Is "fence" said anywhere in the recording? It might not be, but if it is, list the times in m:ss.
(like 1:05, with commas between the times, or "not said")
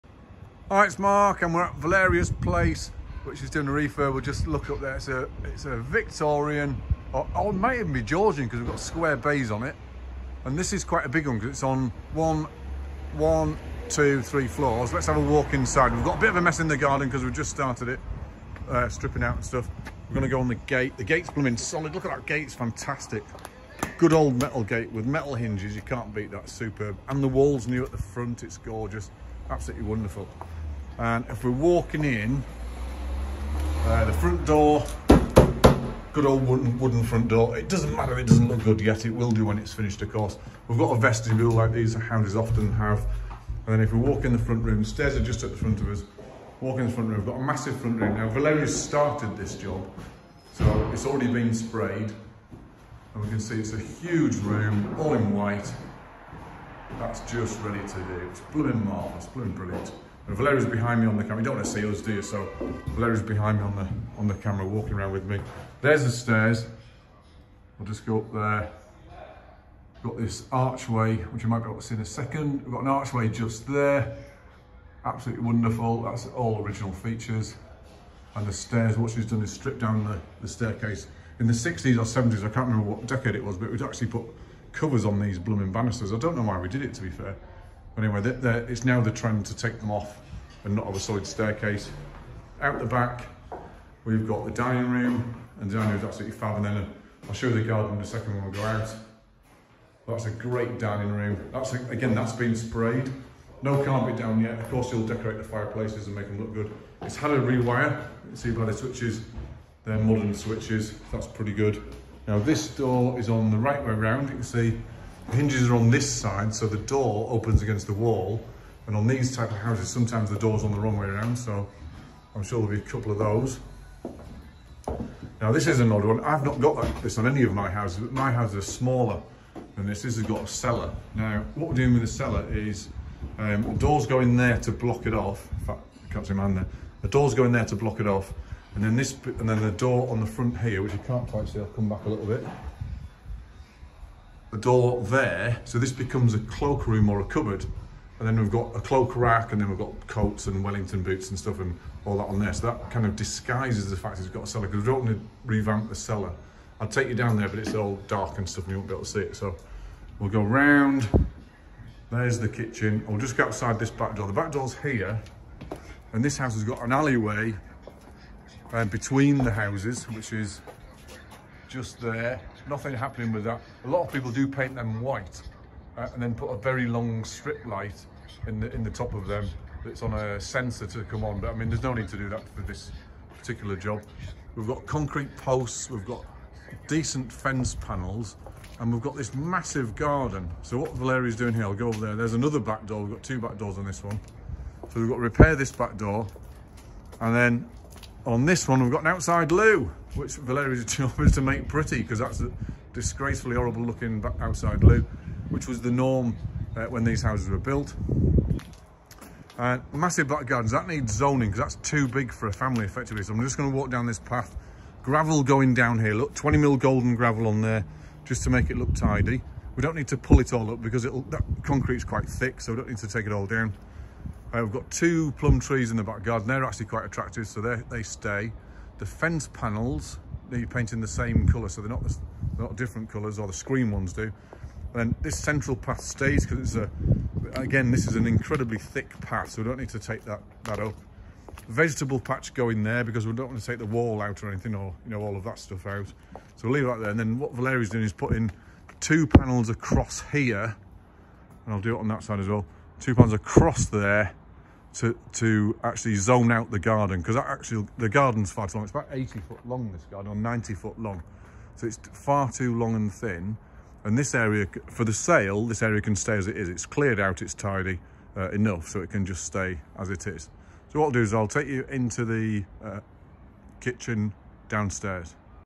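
3:07, 3:49.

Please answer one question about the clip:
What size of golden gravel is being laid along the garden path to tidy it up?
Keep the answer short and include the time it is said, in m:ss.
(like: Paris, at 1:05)
20 mil, at 3:36.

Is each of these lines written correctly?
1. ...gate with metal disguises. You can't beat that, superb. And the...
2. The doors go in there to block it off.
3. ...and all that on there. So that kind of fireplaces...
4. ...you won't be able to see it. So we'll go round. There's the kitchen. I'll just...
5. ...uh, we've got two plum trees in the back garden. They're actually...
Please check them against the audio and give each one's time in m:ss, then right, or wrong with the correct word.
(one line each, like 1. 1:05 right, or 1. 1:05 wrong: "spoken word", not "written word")
1. 0:24 wrong: "hinges", not "disguises"
2. 2:17 right
3. 2:31 wrong: "disguises", not "fireplaces"
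4. 2:38 right
5. 3:44 right.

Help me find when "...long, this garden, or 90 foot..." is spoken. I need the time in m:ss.
4:19.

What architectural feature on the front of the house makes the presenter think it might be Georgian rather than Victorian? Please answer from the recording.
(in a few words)
square bays.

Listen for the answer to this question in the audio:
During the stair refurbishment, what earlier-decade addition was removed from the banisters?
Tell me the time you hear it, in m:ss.
1:24.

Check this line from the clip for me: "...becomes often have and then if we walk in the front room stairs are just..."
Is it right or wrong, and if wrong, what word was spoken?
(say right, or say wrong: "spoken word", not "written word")
wrong: "houses", not "becomes".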